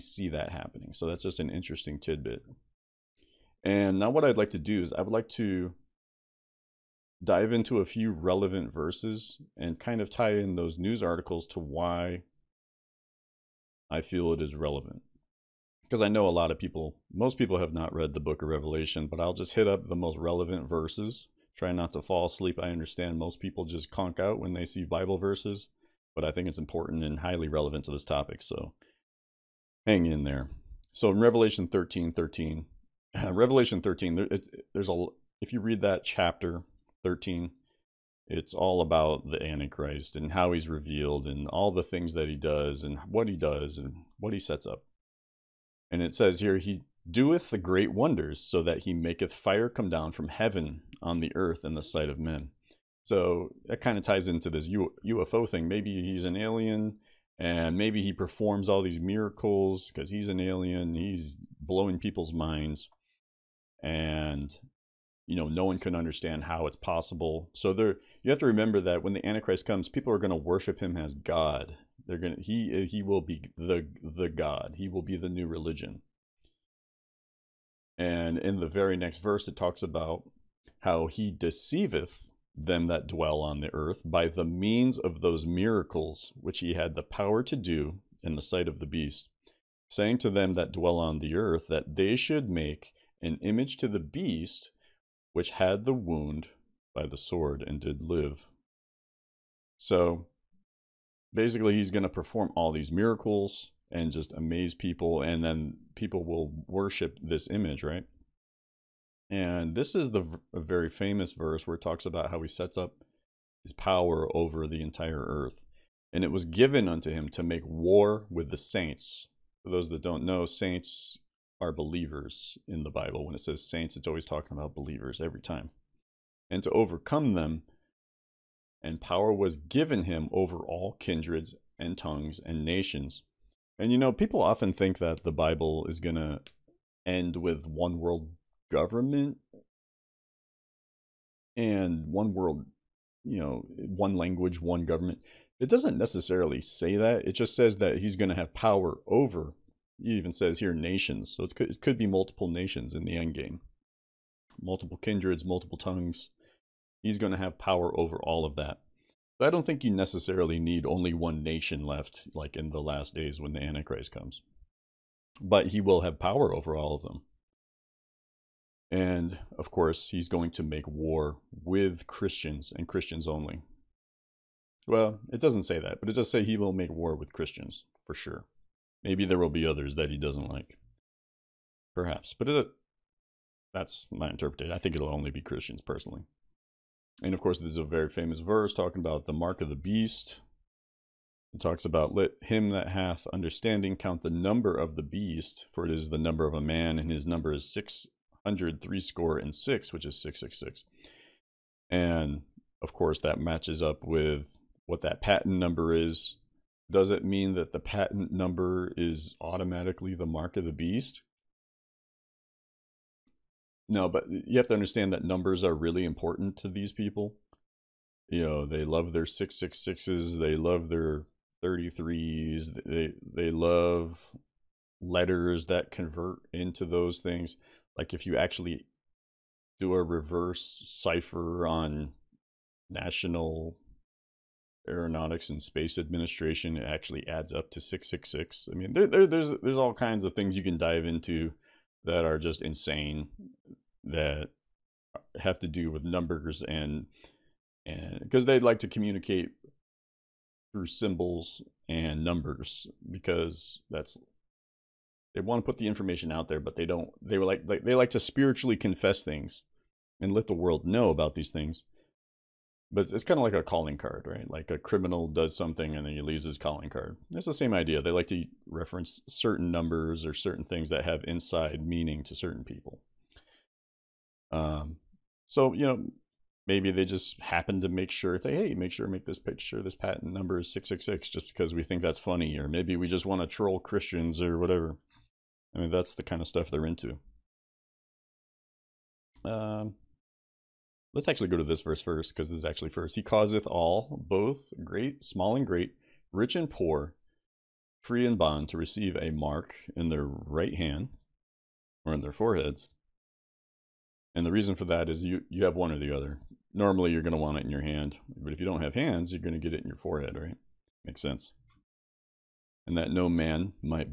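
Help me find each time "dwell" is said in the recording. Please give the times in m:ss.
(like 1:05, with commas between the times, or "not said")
1:23, 1:30.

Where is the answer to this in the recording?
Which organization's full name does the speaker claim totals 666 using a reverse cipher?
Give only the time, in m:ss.
3:52.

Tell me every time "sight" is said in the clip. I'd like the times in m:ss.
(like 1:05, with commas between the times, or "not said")
0:51, 1:28.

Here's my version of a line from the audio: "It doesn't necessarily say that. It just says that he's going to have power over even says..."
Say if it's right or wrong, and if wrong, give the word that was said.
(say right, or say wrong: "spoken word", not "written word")
right.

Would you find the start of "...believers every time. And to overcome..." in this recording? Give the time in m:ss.
2:04.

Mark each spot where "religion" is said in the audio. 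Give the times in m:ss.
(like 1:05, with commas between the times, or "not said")
1:15.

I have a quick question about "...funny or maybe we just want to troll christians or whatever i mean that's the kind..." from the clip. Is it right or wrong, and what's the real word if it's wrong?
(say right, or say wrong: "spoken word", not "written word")
right.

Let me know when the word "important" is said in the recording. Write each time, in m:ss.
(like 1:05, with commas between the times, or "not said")
0:26, 3:36.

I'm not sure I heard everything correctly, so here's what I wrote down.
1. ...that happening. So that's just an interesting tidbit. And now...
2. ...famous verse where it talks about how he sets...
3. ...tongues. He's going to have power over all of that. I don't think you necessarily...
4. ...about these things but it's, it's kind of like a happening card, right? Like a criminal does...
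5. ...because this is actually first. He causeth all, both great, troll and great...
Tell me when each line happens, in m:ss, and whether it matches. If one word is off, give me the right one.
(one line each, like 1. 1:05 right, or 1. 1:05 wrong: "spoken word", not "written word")
1. 0:00 right
2. 1:50 right
3. 2:35 right
4. 4:21 wrong: "calling", not "happening"
5. 4:52 wrong: "small", not "troll".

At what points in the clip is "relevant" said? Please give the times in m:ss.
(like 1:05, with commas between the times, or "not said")
0:08, 0:14, 0:20, 0:27.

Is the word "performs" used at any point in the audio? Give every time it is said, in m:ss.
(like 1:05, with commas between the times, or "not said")
0:58, 1:42.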